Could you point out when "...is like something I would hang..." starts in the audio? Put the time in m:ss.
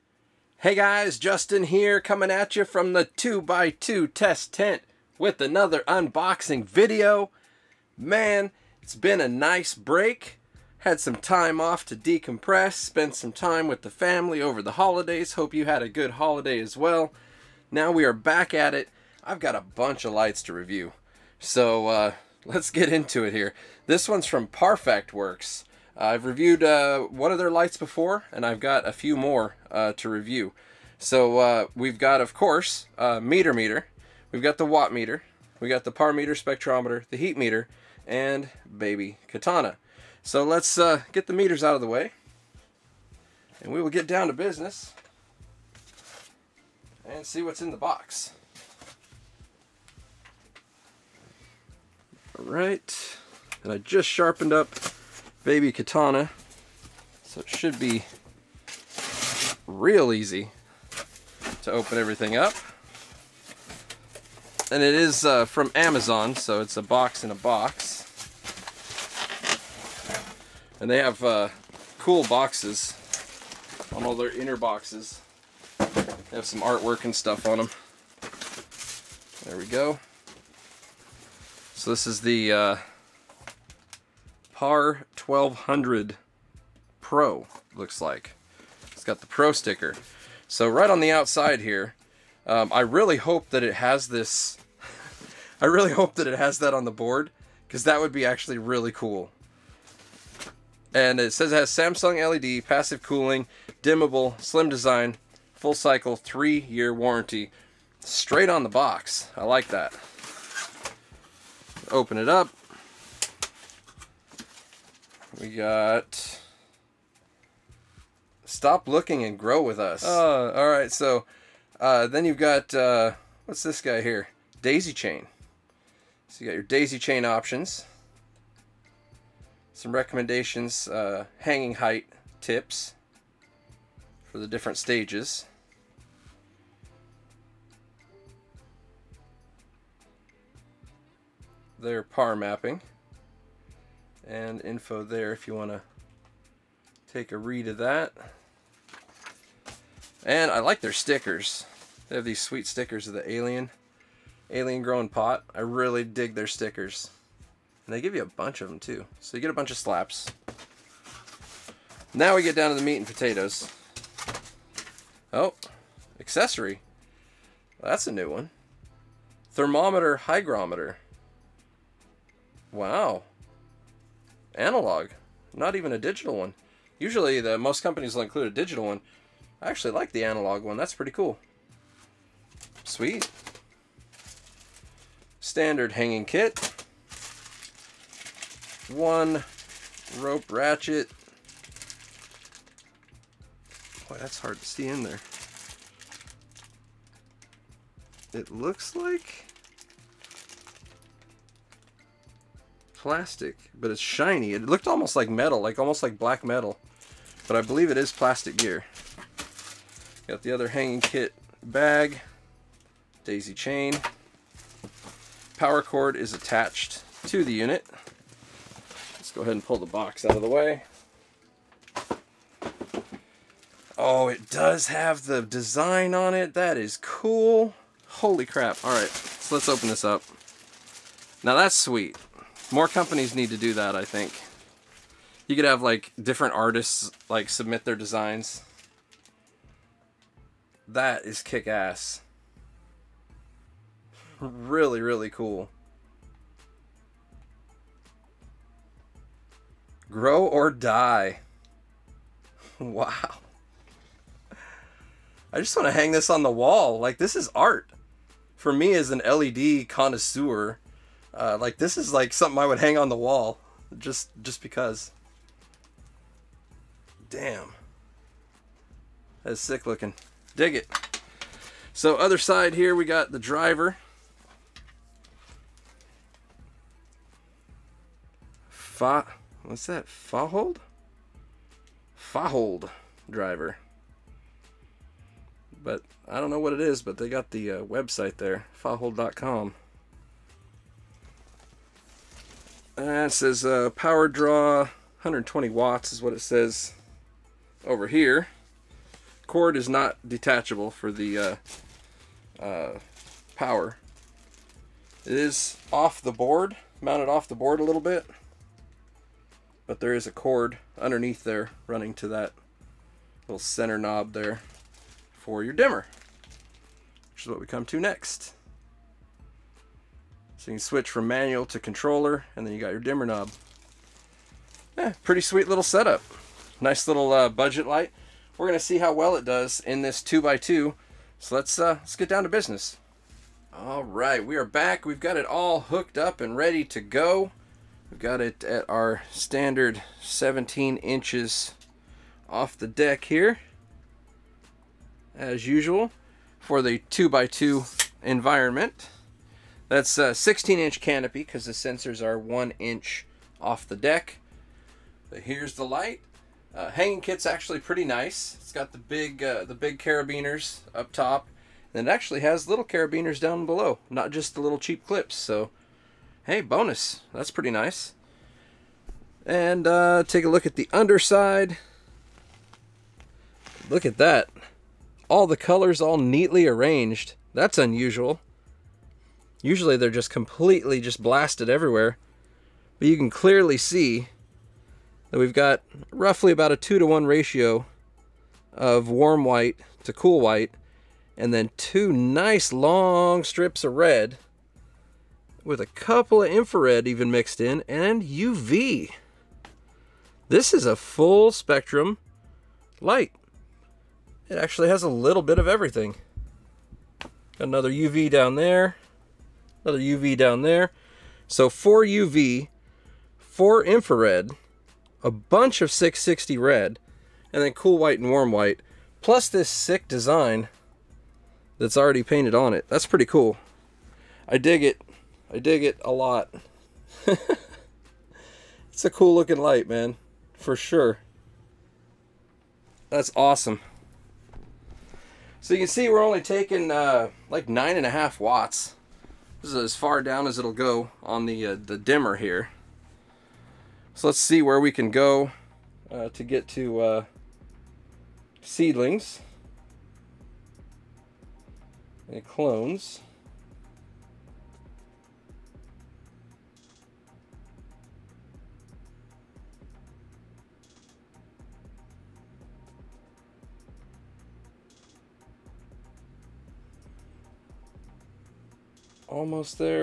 4:21.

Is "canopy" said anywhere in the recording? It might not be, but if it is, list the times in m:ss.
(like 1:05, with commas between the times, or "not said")
5:50.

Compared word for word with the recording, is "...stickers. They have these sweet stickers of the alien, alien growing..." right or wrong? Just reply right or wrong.
right.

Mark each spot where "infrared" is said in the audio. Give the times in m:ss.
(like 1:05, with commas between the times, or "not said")
6:36, 6:53.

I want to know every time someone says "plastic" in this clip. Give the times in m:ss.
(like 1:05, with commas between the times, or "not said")
3:22, 3:28.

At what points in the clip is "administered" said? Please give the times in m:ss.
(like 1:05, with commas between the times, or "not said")
not said.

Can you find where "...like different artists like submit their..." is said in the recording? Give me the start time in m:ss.
3:55.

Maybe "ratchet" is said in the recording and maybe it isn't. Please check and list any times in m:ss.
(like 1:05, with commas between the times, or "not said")
3:10.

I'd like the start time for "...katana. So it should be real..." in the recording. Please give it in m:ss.
0:55.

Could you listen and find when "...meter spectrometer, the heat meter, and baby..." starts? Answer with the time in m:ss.
0:36.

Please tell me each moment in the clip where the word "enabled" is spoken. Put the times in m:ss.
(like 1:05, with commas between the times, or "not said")
not said.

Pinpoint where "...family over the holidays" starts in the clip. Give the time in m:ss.
0:13.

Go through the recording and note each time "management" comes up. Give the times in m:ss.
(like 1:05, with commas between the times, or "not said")
not said.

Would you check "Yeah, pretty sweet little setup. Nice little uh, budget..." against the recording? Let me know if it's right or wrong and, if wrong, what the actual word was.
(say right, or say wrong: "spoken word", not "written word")
right.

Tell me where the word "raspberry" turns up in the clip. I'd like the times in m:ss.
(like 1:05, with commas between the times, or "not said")
not said.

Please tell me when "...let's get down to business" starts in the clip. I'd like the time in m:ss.
5:31.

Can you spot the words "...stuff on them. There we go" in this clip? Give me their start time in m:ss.
1:17.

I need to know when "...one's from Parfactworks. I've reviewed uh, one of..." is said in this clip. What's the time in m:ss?
0:24.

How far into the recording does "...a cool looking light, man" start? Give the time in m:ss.
7:09.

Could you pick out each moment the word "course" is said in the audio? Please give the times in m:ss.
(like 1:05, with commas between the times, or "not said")
0:32.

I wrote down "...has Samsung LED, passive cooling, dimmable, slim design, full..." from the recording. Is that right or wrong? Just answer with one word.
right.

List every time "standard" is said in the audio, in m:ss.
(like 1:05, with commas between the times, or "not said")
3:05, 5:39.